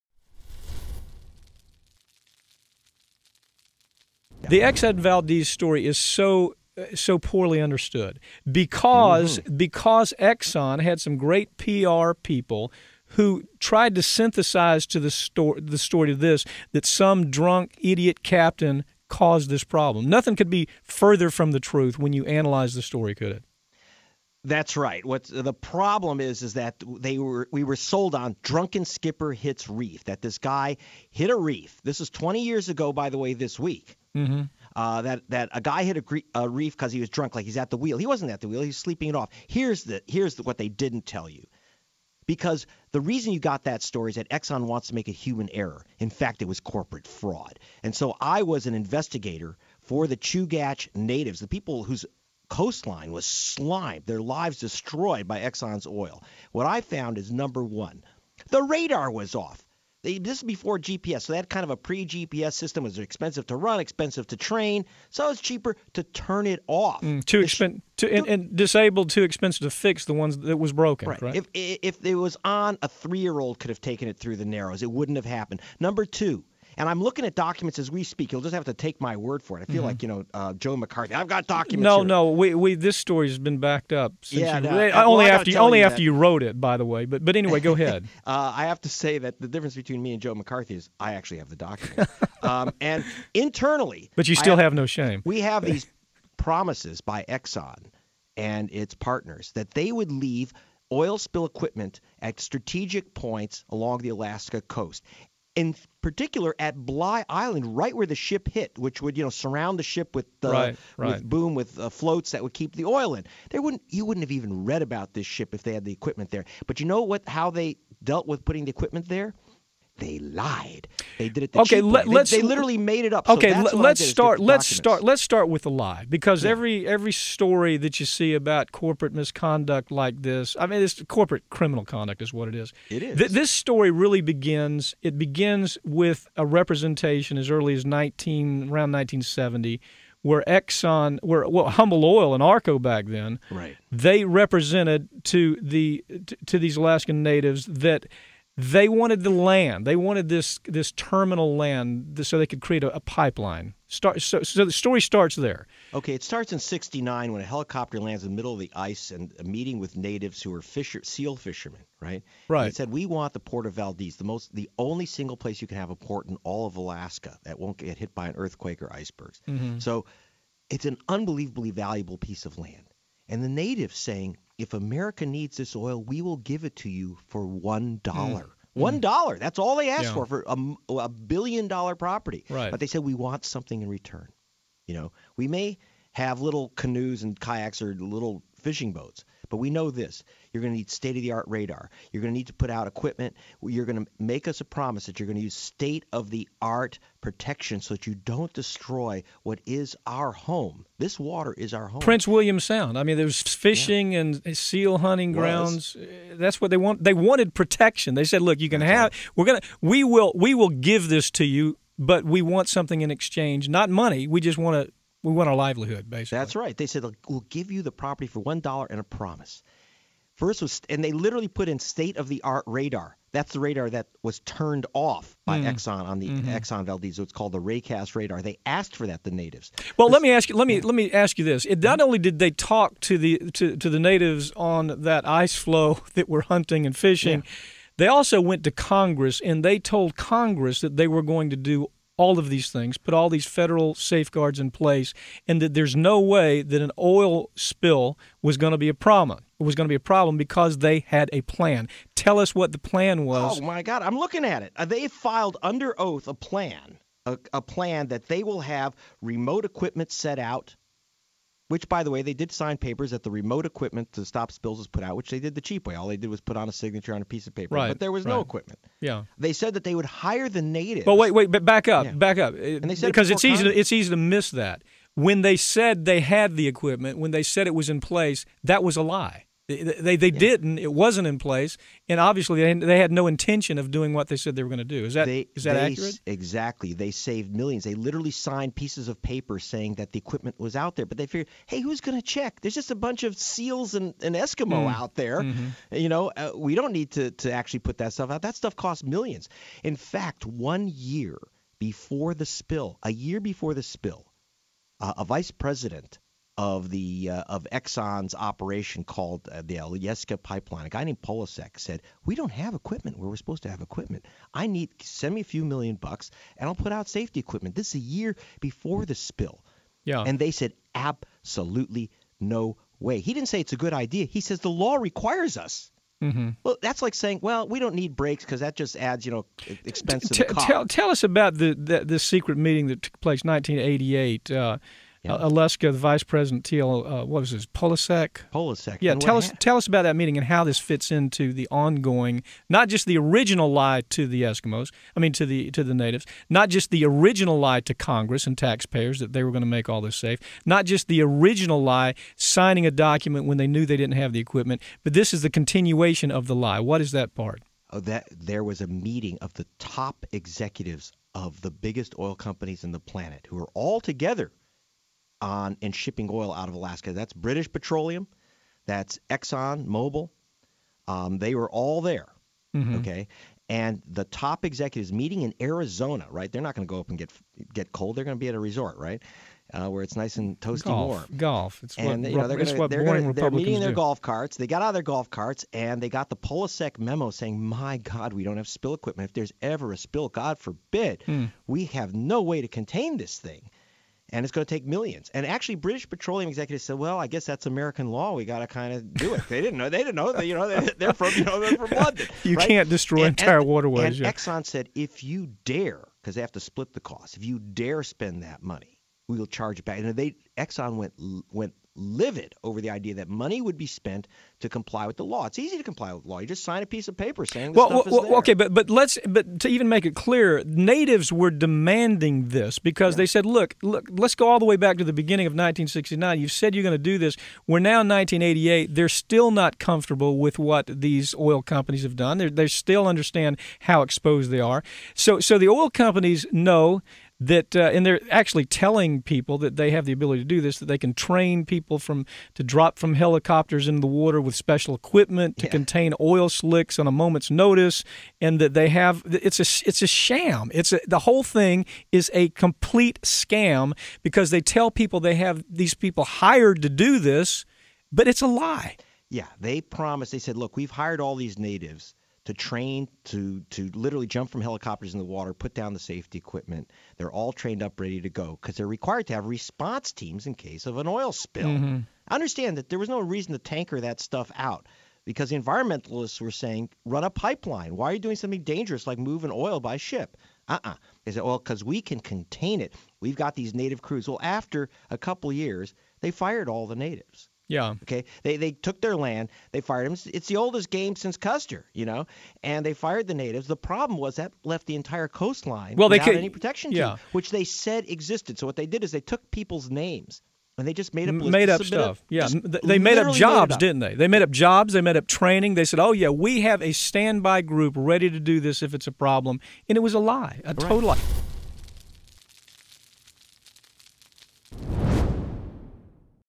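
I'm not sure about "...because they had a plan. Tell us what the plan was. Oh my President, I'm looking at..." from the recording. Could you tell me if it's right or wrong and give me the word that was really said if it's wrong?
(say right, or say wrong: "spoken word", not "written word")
wrong: "God", not "President".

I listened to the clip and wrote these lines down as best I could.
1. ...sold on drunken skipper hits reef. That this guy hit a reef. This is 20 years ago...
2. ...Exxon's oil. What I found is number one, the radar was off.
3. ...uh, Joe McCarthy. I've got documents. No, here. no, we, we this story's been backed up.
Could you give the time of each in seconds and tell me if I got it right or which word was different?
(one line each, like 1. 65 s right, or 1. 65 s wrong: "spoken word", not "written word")
1. 27 s right
2. 55 s right
3. 80 s right.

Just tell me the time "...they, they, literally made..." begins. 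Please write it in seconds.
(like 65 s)
122 s.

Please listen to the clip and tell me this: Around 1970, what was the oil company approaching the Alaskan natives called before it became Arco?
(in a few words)
Humble Oil.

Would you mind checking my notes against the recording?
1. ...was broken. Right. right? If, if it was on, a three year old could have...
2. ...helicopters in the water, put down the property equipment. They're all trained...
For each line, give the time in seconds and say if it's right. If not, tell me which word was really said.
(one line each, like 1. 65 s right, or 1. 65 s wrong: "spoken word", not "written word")
1. 70 s right
2. 464 s wrong: "safety", not "property".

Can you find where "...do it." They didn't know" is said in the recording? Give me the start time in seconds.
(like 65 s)
399 s.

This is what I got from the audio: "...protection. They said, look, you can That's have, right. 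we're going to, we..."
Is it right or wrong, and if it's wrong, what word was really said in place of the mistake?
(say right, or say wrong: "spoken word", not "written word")
right.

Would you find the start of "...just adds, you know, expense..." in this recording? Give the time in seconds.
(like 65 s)
328 s.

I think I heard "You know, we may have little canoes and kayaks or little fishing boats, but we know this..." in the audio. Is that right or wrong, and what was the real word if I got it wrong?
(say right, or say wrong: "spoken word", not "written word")
right.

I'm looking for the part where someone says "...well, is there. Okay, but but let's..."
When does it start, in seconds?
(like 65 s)
418 s.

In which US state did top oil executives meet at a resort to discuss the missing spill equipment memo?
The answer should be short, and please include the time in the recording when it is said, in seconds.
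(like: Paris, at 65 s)
Arizona, at 375 s.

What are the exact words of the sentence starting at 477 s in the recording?
Why are you doing something dangerous like moving oil by ship?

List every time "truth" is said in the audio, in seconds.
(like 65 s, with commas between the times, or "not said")
21 s.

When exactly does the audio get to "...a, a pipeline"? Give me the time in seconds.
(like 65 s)
152 s.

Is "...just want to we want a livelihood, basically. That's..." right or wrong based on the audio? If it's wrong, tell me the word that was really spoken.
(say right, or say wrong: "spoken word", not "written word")
right.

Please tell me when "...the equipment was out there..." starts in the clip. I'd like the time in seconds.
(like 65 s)
290 s.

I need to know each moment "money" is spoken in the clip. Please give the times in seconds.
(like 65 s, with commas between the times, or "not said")
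213 s, 408 s, 413 s.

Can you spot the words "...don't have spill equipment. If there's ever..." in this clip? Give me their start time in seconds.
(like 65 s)
388 s.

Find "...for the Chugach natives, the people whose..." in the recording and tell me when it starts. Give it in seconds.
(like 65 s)
49 s.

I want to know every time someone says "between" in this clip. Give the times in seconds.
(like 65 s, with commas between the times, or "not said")
89 s.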